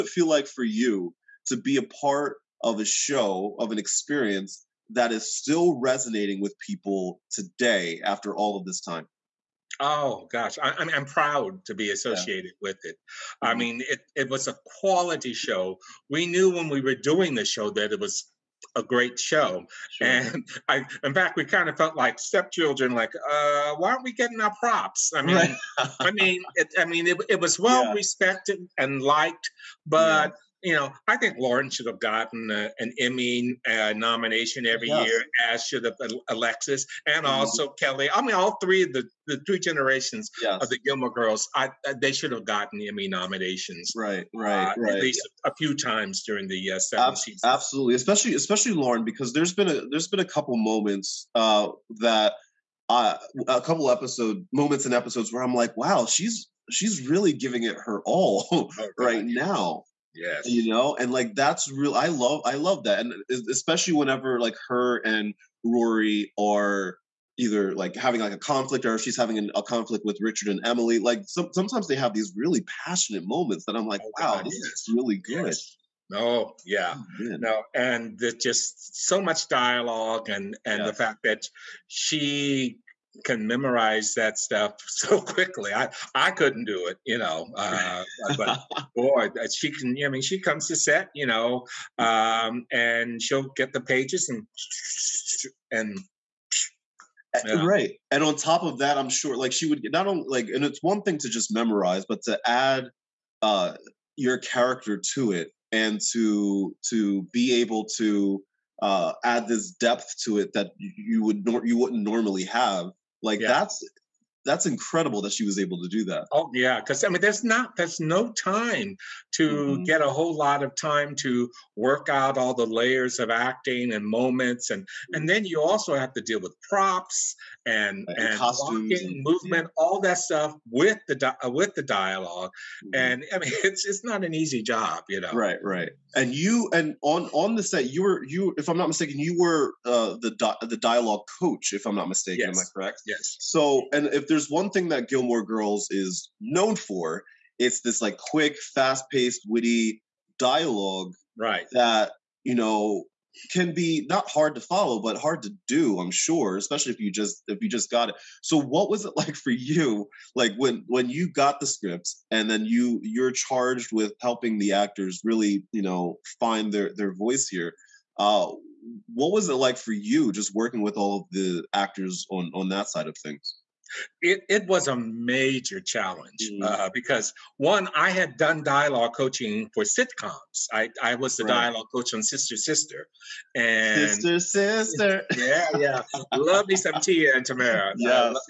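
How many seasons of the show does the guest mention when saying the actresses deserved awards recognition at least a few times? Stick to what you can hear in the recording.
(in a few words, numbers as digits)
7.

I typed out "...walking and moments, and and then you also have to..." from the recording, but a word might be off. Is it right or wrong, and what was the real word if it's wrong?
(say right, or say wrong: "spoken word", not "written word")
wrong: "acting", not "walking".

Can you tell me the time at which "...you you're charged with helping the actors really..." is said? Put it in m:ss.
2:42.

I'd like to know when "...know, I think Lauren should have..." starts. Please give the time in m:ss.
0:30.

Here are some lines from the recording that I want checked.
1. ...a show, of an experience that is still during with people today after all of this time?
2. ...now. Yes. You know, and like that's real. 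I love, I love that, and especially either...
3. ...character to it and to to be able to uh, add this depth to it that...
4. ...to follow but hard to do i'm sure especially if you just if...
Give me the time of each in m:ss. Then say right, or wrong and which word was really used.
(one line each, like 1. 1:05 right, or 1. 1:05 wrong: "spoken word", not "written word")
1. 0:02 wrong: "resonating", not "during"
2. 0:59 wrong: "whenever", not "either"
3. 1:44 right
4. 2:34 right.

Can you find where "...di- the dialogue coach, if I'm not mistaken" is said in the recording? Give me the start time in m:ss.
2:20.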